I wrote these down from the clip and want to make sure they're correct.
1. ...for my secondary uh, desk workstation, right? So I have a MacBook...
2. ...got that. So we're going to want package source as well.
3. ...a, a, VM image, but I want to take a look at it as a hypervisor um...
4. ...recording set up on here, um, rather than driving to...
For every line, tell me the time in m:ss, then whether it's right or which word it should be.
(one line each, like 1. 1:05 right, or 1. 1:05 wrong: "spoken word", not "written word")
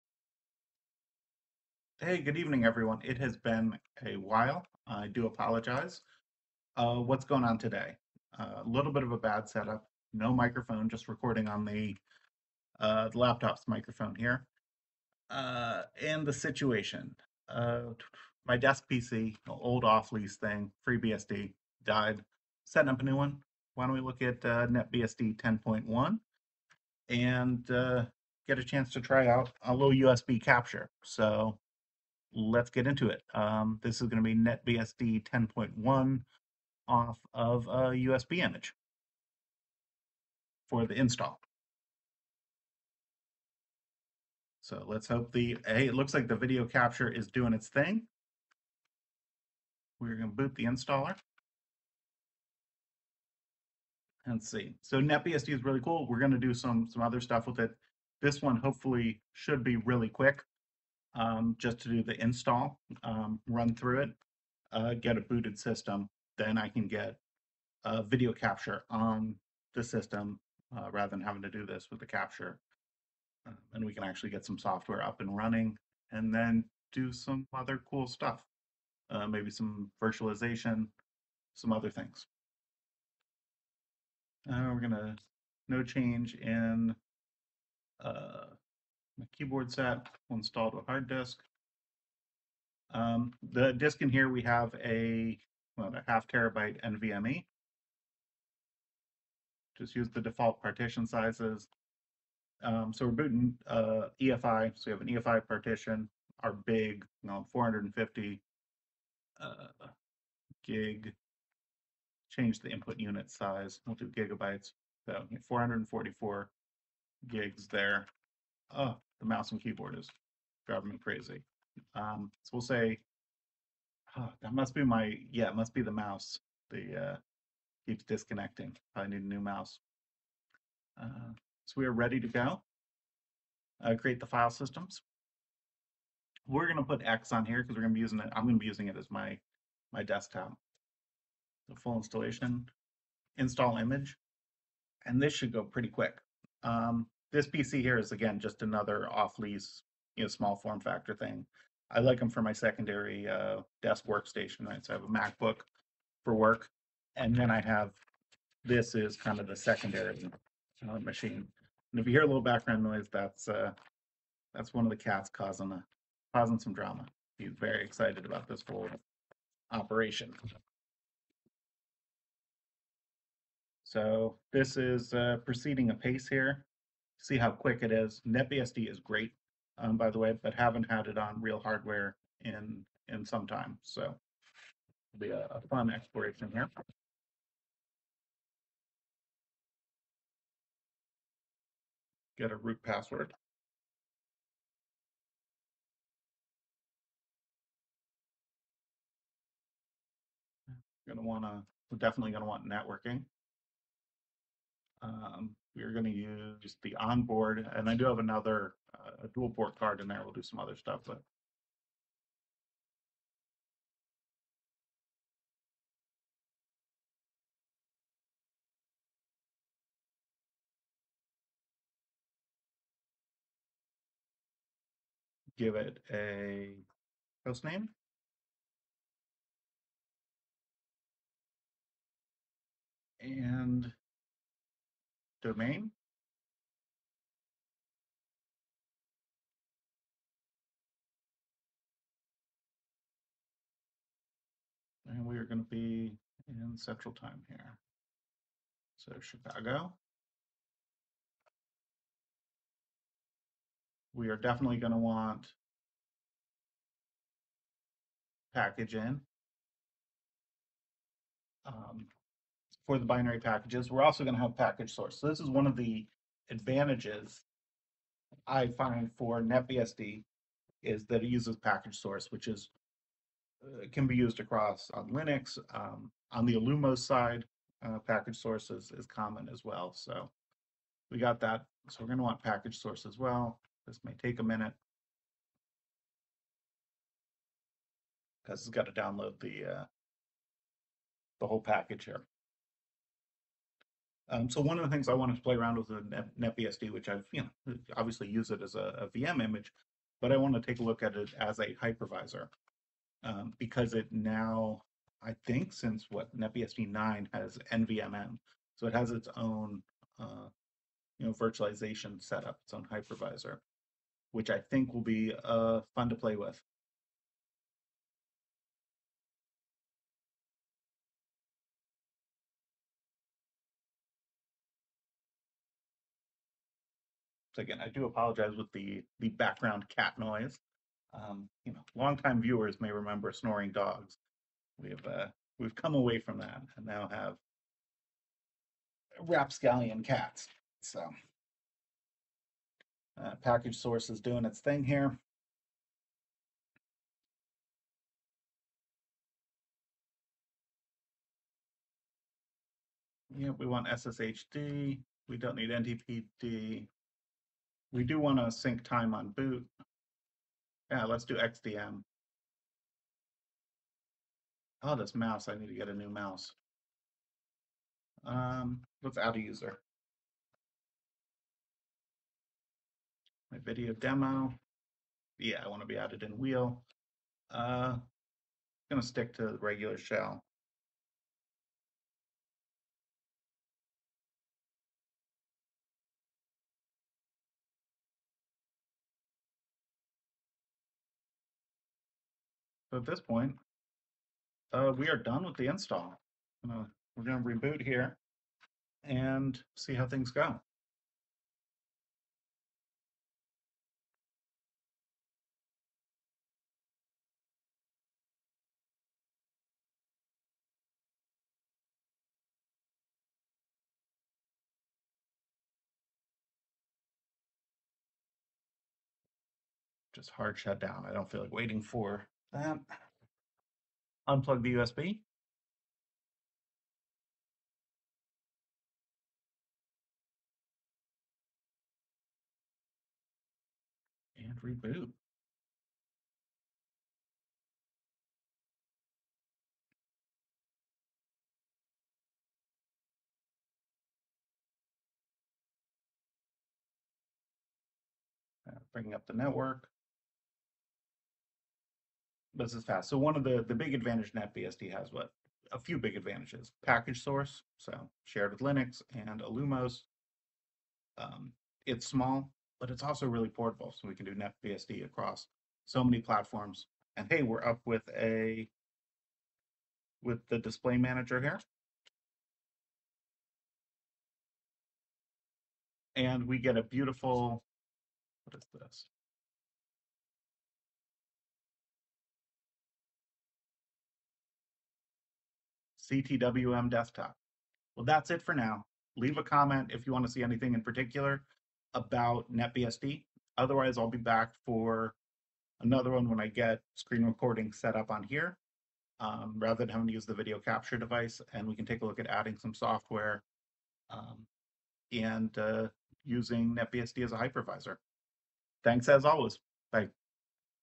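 1. 2:32 right
2. 4:41 right
3. 4:58 right
4. 8:17 wrong: "having", not "driving".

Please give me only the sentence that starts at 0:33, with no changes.
Um, this is going to be NetBSD 10.1 off of a USB image for the install.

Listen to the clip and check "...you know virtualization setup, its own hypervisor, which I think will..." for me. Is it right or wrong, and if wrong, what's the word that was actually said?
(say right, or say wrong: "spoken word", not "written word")
right.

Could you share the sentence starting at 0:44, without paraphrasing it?
So let's hope the, hey, it looks like the video capture is doing its thing.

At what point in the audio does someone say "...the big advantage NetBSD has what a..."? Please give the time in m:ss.
7:33.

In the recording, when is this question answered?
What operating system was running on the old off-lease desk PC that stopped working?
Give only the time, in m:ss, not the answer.
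0:20.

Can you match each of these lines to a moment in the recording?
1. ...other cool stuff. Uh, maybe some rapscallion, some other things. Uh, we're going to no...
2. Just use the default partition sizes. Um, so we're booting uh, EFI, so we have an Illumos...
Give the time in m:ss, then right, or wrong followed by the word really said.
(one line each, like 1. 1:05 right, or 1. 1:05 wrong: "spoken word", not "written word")
1. 1:17 wrong: "virtualization", not "rapscallion"
2. 1:39 wrong: "EFI", not "Illumos".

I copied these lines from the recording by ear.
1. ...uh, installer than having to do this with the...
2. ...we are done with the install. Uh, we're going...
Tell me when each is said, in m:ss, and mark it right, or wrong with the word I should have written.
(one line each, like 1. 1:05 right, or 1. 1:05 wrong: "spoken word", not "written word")
1. 1:10 wrong: "rather", not "installer"
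2. 6:34 right.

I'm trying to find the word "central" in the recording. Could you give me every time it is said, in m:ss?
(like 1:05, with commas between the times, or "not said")
4:06.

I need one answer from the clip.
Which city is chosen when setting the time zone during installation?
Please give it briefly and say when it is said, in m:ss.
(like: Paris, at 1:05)
Chicago, at 4:09.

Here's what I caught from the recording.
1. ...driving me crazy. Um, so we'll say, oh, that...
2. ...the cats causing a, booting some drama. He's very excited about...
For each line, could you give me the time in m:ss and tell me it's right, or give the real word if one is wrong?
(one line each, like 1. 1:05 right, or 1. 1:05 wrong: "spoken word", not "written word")
1. 2:00 right
2. 2:44 wrong: "causing", not "booting".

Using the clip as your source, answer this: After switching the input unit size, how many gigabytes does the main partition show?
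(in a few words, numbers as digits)
444.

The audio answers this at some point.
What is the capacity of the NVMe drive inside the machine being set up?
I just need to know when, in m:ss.
1:36.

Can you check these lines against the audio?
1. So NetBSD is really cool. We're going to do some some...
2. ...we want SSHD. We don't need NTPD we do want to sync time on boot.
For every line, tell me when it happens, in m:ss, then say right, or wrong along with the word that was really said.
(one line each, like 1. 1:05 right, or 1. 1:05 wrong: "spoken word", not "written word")
1. 0:54 right
2. 5:53 right.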